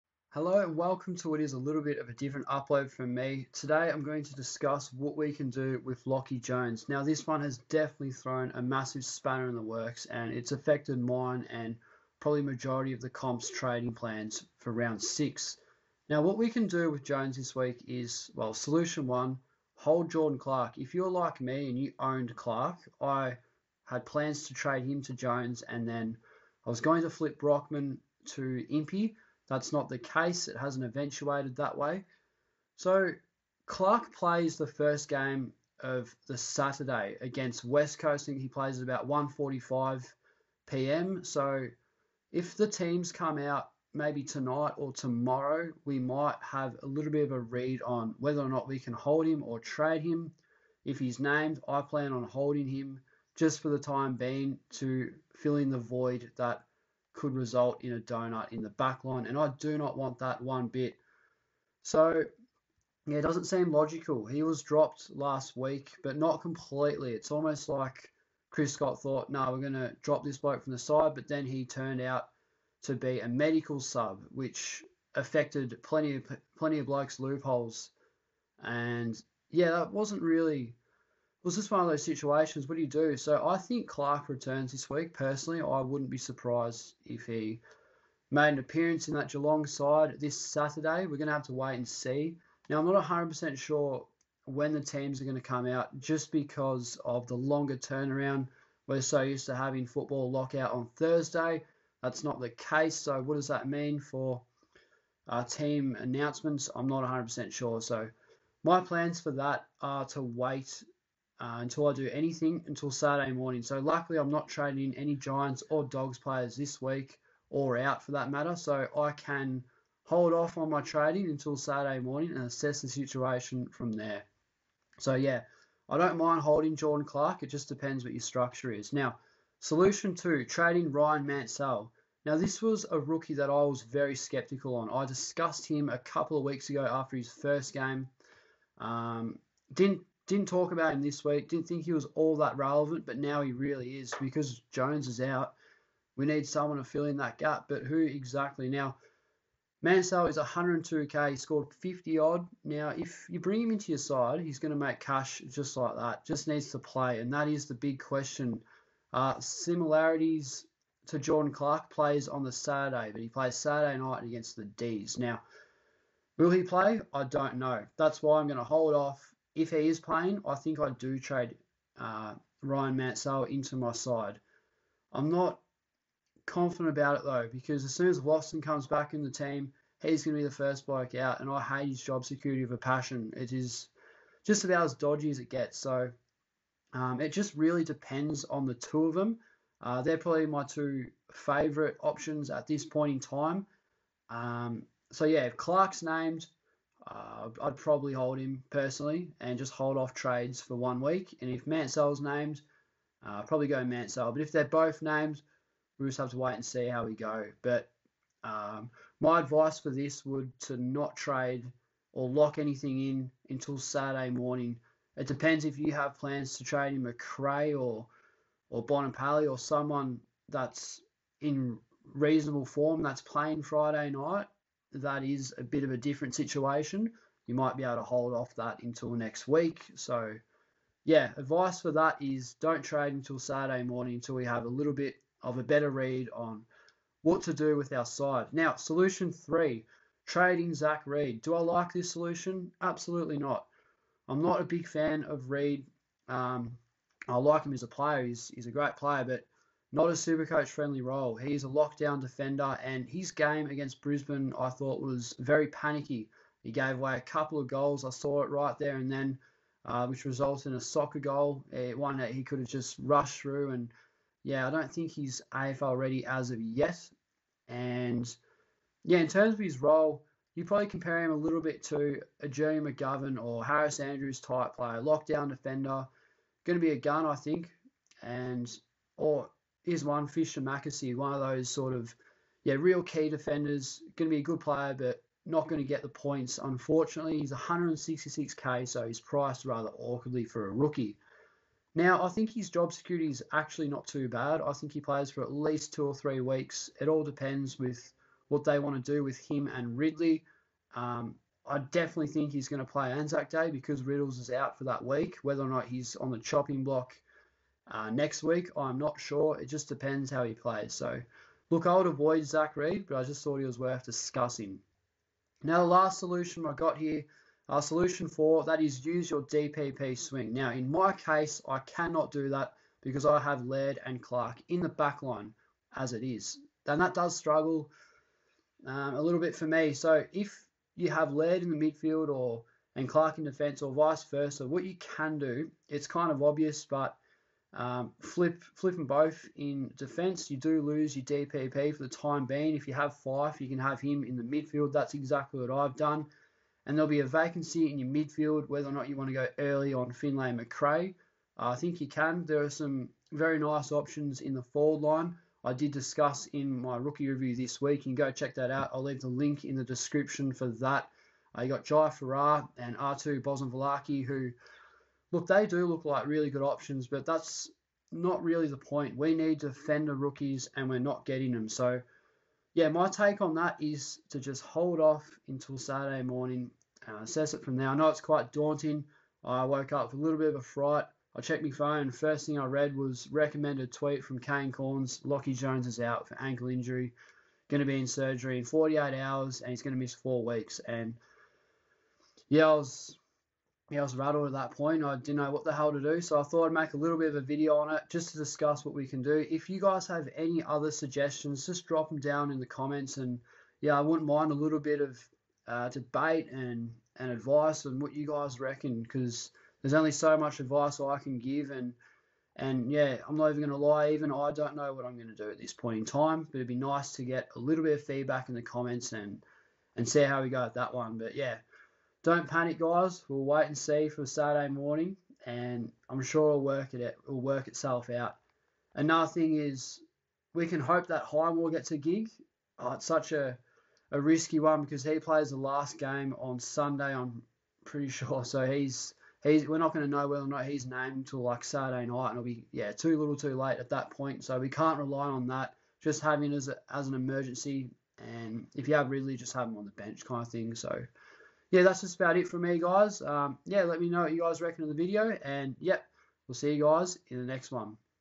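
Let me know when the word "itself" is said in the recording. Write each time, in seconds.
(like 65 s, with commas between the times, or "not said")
427 s.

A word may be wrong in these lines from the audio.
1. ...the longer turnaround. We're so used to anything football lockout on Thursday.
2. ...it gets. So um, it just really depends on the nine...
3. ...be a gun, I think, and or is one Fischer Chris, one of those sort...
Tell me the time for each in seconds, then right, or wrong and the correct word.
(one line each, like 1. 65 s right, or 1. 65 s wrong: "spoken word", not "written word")
1. 97 s wrong: "having", not "anything"
2. 185 s wrong: "two", not "nine"
3. 276 s wrong: "McAsey", not "Chris".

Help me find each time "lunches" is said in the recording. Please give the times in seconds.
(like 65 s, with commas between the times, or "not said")
not said.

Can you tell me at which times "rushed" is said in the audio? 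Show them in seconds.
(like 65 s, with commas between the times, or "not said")
263 s.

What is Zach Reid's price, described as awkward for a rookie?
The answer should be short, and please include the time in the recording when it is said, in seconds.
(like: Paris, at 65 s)
166k, at 287 s.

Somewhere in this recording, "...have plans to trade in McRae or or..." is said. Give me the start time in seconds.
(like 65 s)
215 s.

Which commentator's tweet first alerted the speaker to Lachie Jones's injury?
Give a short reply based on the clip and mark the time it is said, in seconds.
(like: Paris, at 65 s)
Kane Cornes, at 384 s.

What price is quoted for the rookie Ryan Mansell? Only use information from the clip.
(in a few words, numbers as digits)
102k.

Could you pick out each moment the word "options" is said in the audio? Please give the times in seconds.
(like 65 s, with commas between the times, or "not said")
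191 s, 353 s, 366 s.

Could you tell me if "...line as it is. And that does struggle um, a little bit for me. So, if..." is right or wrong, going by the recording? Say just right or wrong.
right.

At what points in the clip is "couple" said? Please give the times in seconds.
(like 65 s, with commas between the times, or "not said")
135 s, 257 s.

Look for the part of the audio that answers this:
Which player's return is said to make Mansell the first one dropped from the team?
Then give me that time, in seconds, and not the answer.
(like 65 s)
178 s.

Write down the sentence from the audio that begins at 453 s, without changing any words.
Um, yeah, let me know what you guys reckon of the video.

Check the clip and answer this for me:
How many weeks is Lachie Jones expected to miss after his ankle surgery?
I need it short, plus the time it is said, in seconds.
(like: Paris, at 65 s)
4, at 390 s.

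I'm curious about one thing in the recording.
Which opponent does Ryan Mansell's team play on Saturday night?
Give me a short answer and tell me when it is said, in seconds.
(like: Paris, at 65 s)
the D's, at 164 s.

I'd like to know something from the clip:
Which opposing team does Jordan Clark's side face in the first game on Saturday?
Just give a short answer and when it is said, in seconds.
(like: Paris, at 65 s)
West Coast, at 37 s.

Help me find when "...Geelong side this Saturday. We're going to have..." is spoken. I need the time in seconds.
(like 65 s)
89 s.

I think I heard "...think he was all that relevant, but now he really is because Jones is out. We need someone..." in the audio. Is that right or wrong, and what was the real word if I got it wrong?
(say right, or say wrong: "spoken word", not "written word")
right.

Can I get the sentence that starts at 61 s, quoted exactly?
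So, yeah, it doesn't seem logical.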